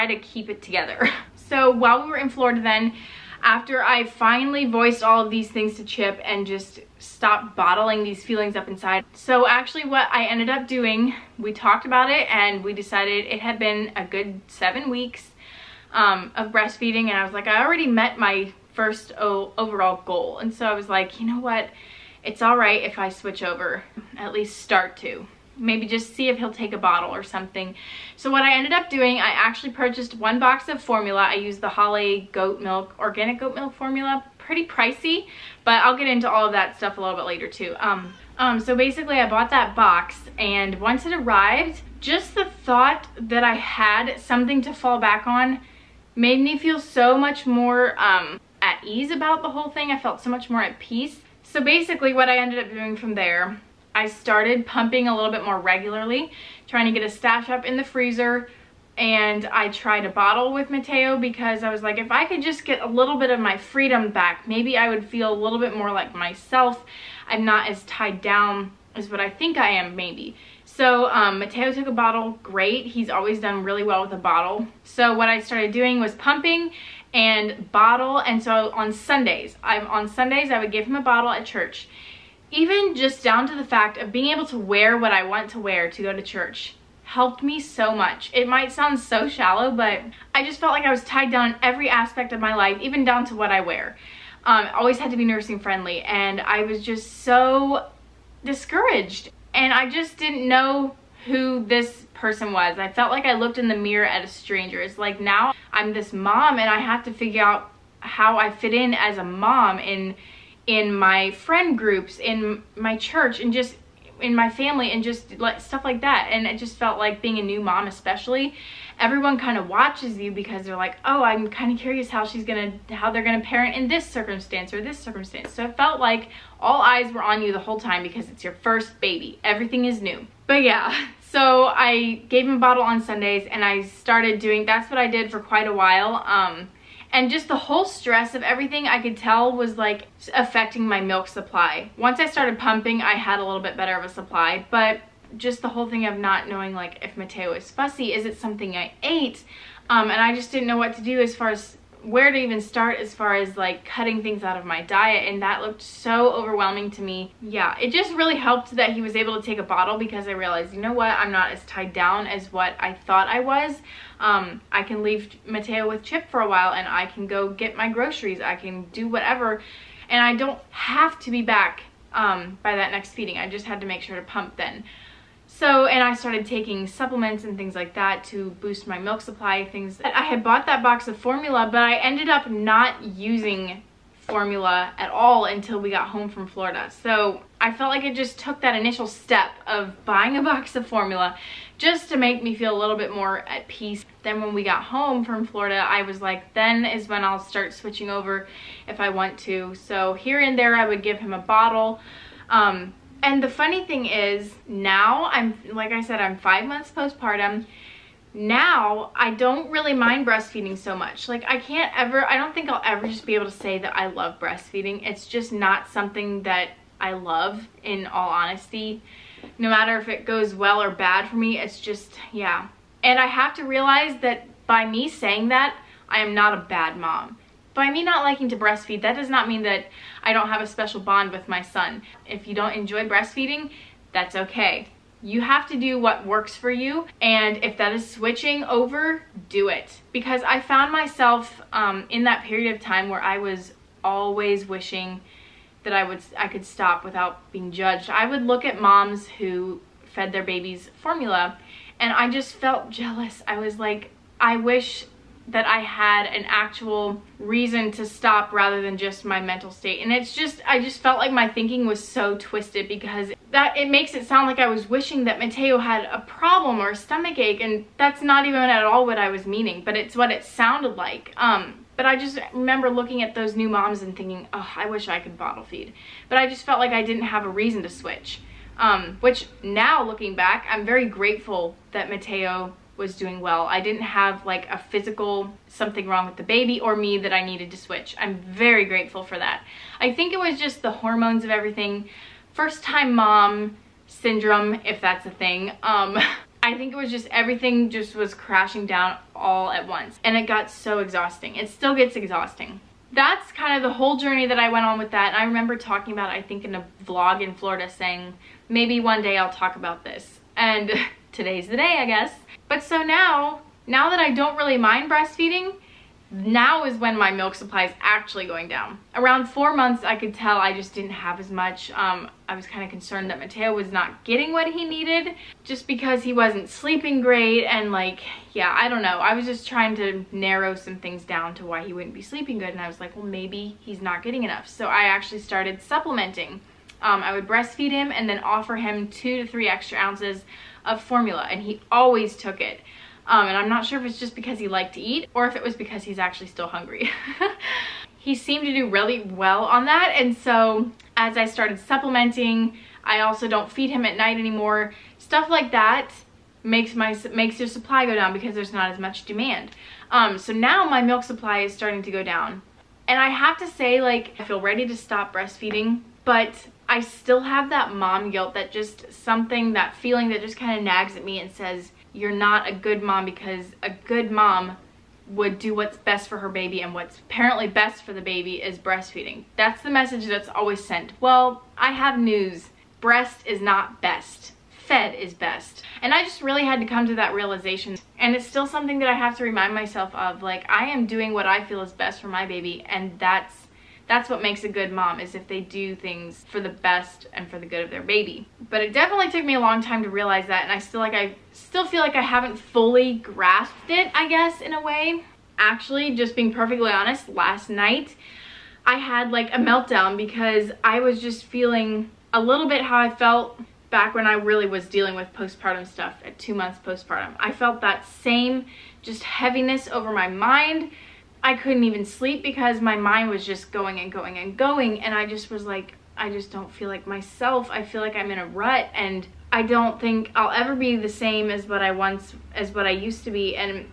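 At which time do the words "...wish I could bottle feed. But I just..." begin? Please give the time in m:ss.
4:34.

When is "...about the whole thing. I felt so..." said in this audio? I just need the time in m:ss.
0:49.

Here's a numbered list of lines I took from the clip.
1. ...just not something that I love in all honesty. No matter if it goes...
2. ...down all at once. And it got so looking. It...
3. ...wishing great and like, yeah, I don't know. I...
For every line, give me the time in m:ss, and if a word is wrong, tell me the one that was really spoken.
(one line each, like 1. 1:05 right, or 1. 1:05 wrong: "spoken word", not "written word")
1. 3:35 right
2. 4:58 wrong: "exhausting", not "looking"
3. 5:26 wrong: "sleeping", not "wishing".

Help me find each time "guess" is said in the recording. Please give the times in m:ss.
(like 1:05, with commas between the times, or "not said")
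5:12, 6:44.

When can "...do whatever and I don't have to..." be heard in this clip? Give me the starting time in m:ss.
2:48.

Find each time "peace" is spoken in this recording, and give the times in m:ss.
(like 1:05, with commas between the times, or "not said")
0:50, 3:13.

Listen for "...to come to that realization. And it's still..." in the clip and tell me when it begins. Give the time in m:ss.
6:26.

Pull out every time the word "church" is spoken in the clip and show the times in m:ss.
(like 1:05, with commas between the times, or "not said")
1:21, 1:26, 1:52.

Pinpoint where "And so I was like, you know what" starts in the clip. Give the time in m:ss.
0:20.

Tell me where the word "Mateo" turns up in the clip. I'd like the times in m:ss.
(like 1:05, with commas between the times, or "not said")
1:00, 1:11, 2:27, 2:45, 4:25, 4:42, 5:23.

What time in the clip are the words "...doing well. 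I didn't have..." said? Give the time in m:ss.
4:43.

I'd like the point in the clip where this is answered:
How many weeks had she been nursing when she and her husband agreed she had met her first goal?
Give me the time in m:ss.
0:14.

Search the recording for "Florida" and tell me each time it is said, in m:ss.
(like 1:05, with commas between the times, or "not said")
0:02, 3:06, 3:15, 5:07.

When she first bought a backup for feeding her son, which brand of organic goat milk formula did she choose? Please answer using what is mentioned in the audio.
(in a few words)
Holle.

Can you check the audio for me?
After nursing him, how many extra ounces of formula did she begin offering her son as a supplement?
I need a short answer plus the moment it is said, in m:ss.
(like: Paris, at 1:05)
2 to 3, at 5:39.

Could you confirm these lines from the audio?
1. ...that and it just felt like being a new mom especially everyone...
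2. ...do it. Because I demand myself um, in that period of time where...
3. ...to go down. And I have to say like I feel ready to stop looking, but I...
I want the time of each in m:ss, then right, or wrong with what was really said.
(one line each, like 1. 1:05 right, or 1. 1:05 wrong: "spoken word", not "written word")
1. 1:55 right
2. 3:59 wrong: "found", not "demand"
3. 6:02 wrong: "breastfeeding", not "looking".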